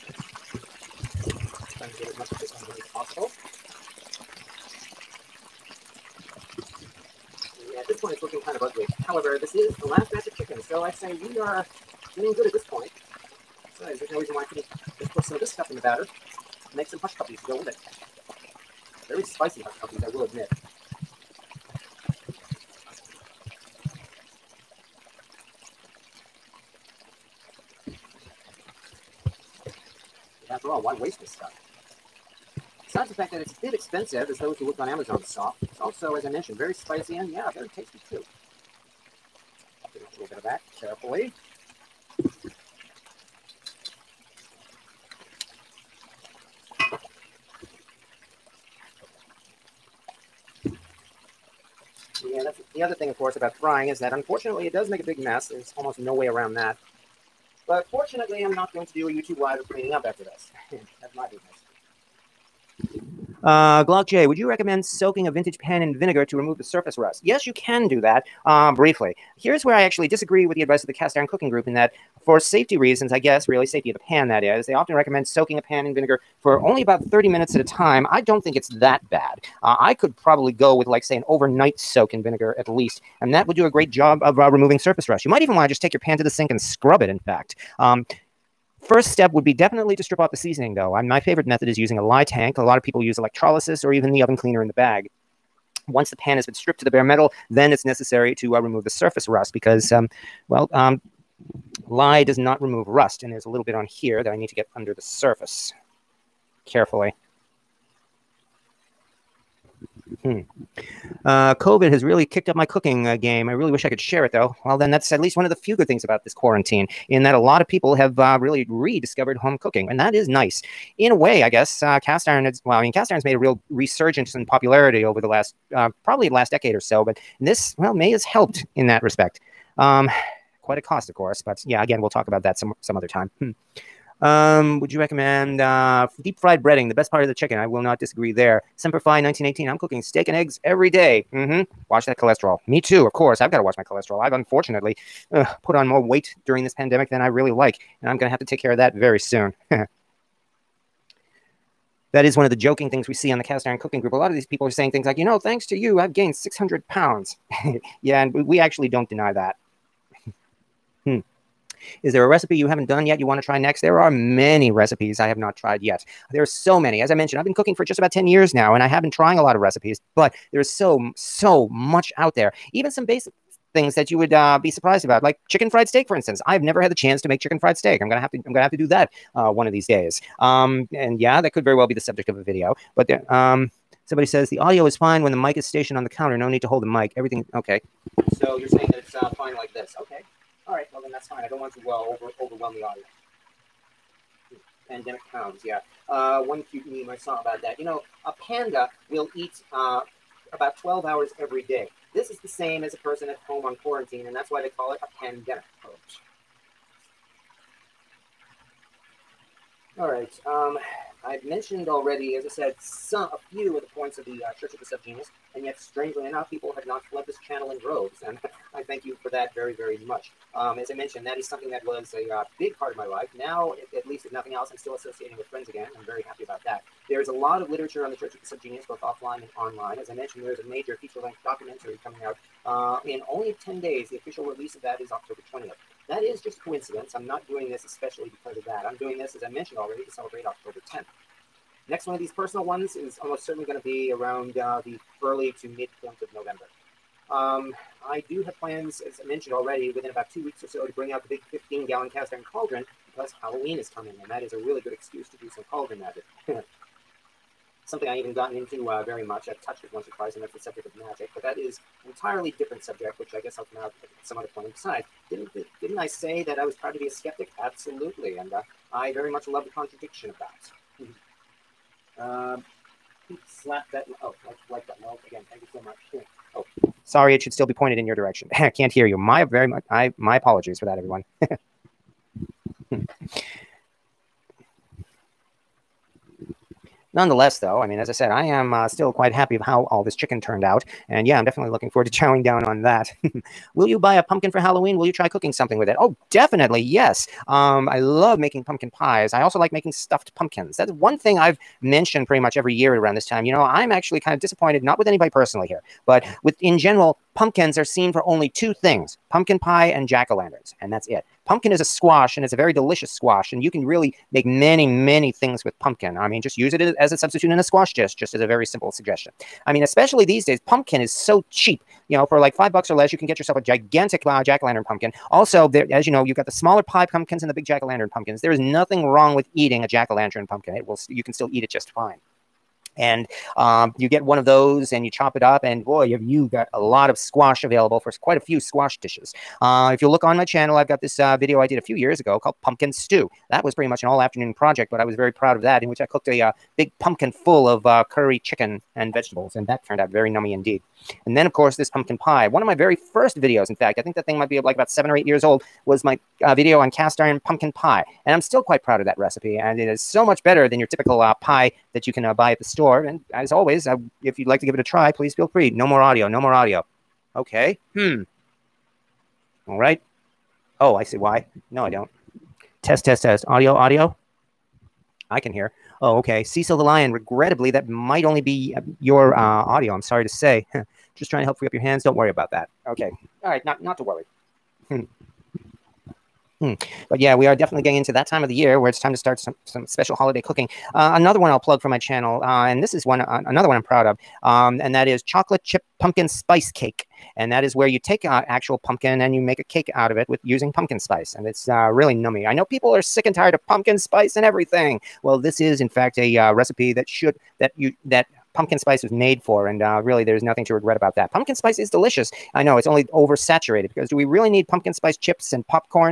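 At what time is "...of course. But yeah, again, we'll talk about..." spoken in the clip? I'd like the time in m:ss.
2:11.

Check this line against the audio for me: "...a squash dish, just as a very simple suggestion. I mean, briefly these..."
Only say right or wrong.
wrong.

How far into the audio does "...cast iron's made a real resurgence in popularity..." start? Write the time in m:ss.
2:02.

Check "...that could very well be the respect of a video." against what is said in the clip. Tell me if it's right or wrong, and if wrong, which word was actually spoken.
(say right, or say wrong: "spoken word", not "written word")
wrong: "subject", not "respect".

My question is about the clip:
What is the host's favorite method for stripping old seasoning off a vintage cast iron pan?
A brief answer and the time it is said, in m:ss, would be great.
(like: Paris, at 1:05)
Lye tank, at 1:32.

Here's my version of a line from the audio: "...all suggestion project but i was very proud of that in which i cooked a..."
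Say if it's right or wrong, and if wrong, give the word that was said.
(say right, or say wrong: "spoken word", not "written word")
wrong: "afternoon", not "suggestion".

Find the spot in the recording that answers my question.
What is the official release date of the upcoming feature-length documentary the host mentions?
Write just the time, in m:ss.
3:55.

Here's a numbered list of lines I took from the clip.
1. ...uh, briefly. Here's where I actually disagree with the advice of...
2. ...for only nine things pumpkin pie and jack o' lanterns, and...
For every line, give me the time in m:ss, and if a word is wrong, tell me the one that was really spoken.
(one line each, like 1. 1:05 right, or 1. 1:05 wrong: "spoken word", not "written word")
1. 1:08 right
2. 5:08 wrong: "two", not "nine".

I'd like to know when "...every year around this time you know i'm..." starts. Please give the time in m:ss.
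5:02.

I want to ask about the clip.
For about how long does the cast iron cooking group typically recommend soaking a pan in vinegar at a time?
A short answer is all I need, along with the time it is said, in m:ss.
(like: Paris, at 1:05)
30 minutes, at 1:17.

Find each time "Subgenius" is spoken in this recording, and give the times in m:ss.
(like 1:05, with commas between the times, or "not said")
3:34, 3:48.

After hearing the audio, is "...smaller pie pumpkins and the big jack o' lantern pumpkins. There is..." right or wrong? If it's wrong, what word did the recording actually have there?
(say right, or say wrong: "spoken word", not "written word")
right.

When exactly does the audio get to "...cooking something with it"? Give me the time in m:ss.
4:55.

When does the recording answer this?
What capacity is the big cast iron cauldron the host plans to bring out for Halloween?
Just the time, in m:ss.
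4:11.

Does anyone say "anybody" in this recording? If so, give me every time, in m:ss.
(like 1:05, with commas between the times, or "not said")
5:05.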